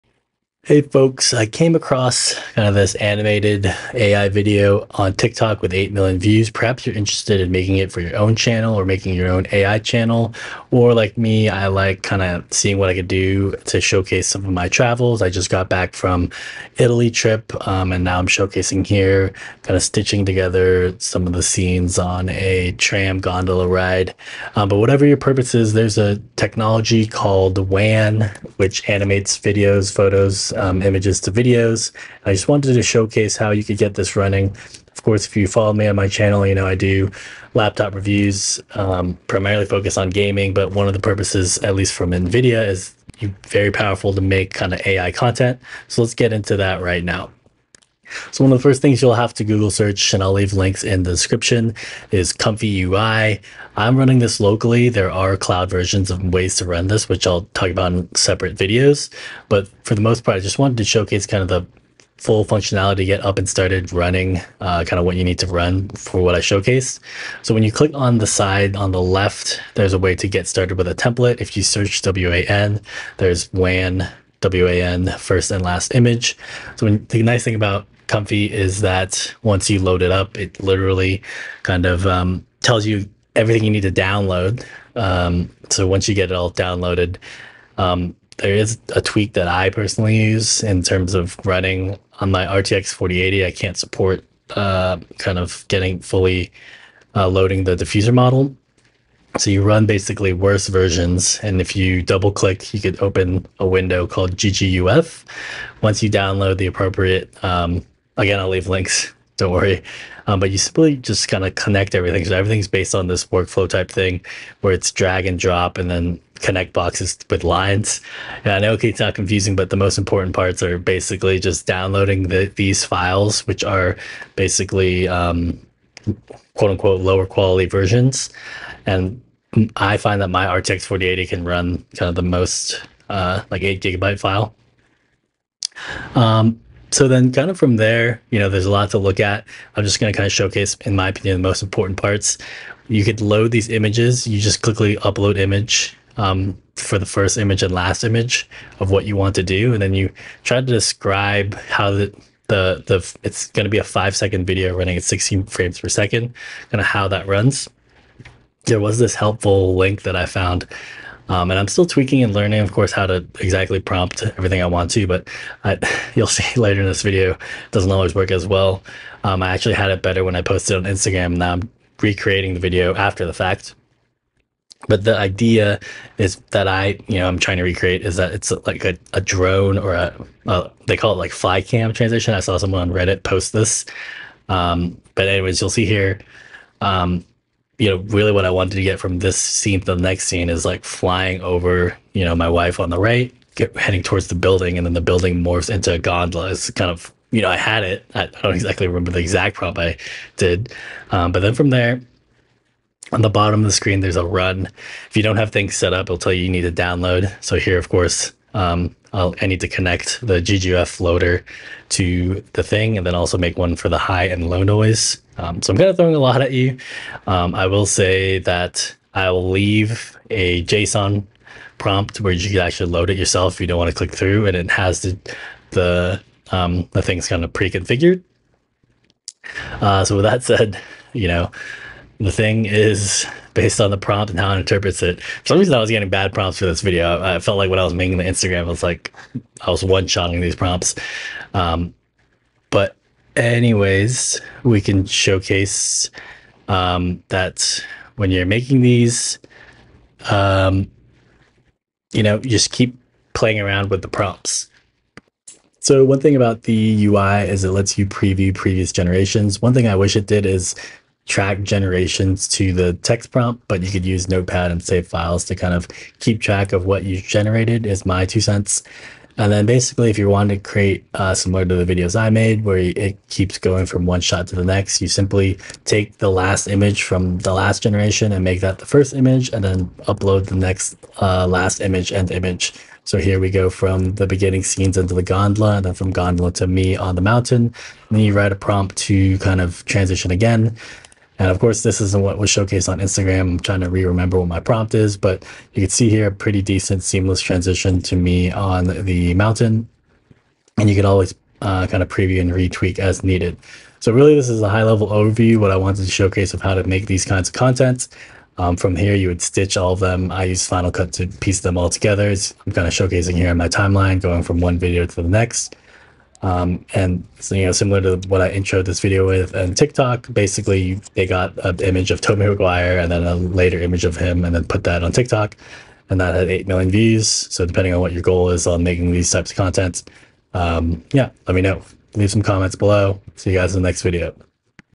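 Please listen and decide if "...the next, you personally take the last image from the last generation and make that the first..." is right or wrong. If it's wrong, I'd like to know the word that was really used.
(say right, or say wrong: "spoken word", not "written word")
wrong: "simply", not "personally".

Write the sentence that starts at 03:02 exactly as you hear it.
I saw someone on Reddit post this.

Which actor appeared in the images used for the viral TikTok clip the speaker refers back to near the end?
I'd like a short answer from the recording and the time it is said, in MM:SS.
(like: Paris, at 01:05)
Tobey Maguire, at 05:22.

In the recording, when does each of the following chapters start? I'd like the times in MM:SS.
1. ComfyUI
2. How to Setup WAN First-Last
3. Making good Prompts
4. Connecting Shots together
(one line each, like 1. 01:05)
1. 00:50
2. 01:07
3. 02:19
4. 04:25.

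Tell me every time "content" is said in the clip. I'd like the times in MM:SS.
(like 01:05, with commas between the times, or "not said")
00:45, 05:07, 05:29.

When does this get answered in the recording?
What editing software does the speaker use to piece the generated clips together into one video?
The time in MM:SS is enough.
05:10.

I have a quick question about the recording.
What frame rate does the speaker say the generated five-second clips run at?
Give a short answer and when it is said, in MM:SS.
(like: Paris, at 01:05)
16 frames per second, at 02:35.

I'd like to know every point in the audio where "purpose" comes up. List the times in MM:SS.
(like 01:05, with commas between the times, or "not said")
00:25, 00:40.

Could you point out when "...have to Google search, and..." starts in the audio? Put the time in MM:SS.
00:49.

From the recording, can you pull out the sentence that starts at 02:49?
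Um, I actually had it better when I posted on Instagram.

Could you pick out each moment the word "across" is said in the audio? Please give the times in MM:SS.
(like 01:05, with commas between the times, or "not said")
00:01.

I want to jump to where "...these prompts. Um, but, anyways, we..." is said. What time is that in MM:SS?
04:00.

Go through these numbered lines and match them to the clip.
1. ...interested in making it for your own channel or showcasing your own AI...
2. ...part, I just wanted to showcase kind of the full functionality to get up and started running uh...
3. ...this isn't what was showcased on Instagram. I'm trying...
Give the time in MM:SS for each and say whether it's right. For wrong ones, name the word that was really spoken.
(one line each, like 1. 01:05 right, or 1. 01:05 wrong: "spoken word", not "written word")
1. 00:06 wrong: "making", not "showcasing"
2. 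01:00 right
3. 04:51 right.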